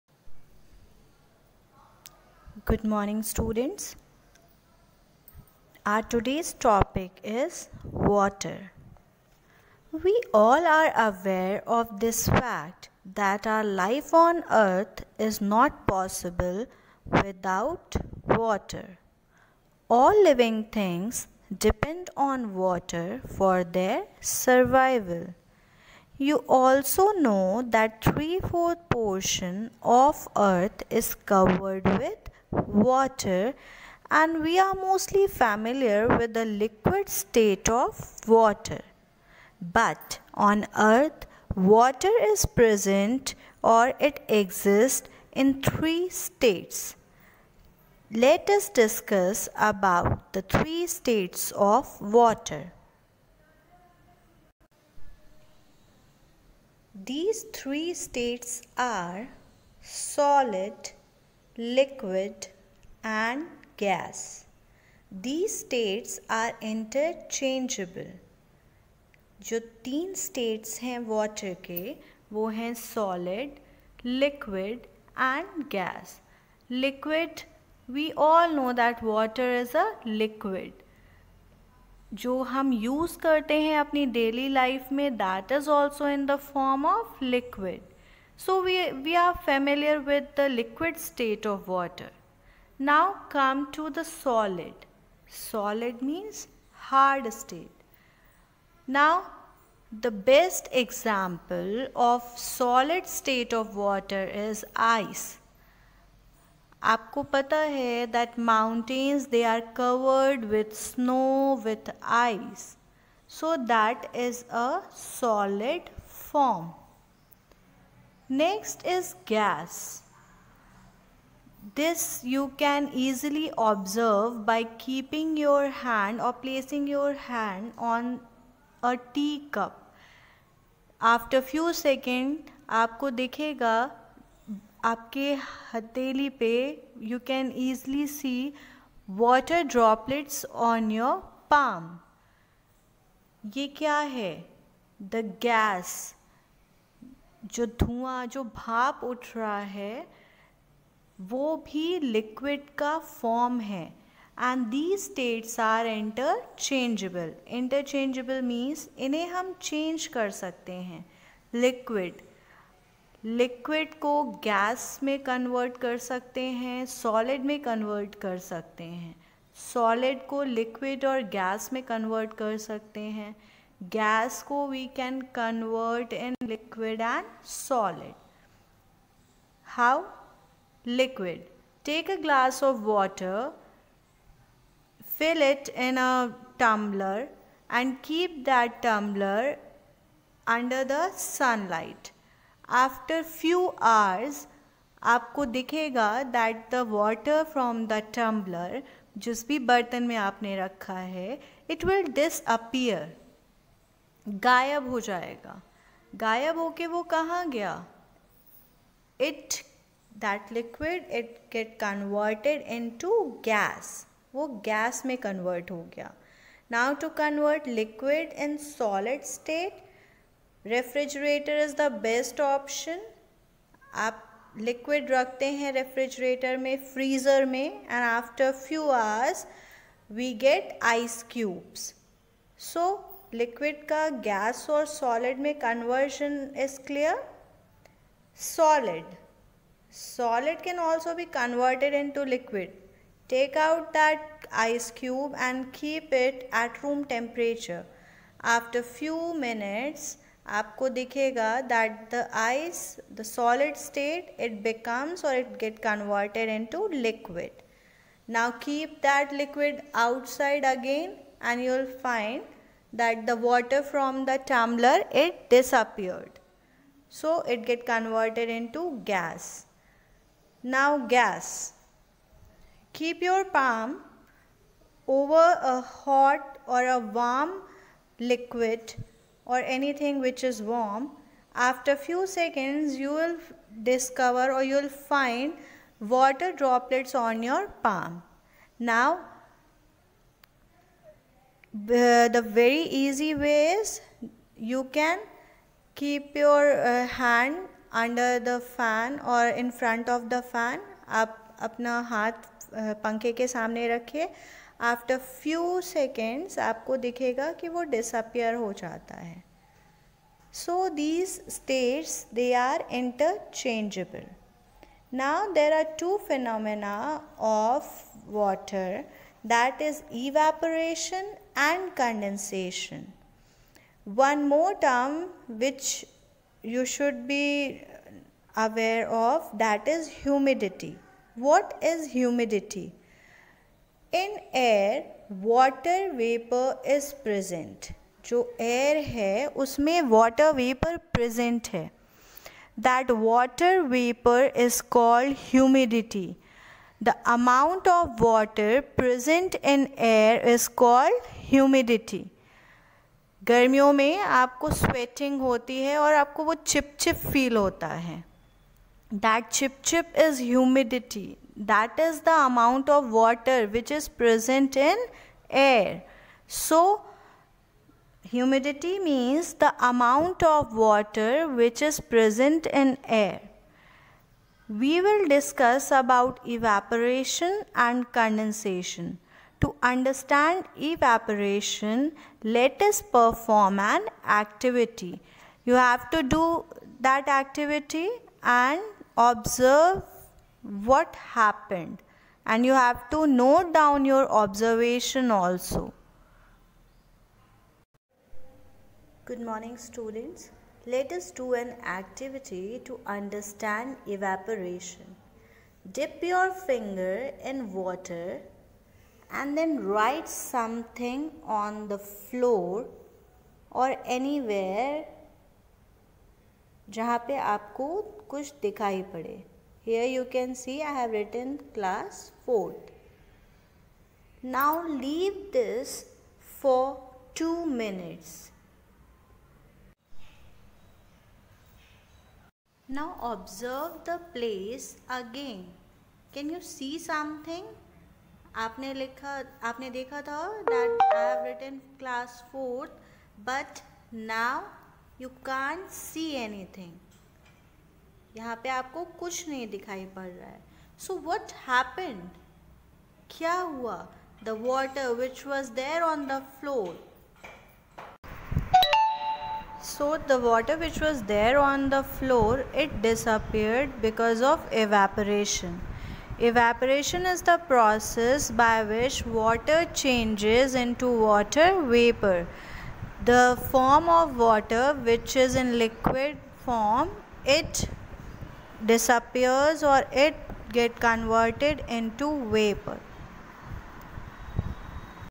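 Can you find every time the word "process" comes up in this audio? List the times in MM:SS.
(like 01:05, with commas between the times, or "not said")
07:47.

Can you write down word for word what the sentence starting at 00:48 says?
Let us discuss about the three states of water.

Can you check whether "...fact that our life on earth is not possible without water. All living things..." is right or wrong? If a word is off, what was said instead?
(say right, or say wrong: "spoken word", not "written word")
right.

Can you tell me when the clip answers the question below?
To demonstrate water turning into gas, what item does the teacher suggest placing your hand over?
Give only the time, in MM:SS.
02:09.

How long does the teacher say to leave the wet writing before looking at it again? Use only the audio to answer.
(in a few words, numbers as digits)
2 minutes.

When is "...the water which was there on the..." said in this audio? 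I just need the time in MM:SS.
07:40.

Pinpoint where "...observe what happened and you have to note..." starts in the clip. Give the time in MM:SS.
06:29.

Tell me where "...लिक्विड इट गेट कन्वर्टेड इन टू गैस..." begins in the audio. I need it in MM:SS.
03:30.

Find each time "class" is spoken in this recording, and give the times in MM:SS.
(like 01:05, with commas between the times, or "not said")
07:01, 07:22.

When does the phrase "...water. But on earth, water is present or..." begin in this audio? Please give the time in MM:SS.
00:38.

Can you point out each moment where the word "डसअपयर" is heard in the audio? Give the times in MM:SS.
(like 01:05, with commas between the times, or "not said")
03:22, 05:07.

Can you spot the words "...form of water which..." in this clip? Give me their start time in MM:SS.
07:53.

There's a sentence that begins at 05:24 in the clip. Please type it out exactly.
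One more term which you should be aware of that is humidity.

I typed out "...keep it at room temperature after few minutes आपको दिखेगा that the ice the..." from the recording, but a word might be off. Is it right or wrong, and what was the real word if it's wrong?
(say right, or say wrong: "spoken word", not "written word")
right.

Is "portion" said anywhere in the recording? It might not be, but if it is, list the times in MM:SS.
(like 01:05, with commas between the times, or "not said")
00:28.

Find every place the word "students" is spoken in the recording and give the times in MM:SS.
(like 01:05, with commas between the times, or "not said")
00:03, 06:39.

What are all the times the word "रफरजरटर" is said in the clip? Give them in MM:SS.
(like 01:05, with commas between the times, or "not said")
03:40, 03:45.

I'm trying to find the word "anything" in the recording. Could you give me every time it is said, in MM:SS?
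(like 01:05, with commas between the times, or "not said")
04:39, 07:26.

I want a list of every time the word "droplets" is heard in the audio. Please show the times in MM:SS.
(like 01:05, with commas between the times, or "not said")
02:19, 04:46.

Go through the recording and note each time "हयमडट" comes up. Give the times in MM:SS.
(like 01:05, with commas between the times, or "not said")
05:51, 06:00, 06:08.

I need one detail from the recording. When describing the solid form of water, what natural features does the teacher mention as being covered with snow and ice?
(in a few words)
mountains.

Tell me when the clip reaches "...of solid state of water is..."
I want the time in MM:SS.
01:41.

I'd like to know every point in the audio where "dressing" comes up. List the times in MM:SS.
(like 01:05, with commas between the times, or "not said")
not said.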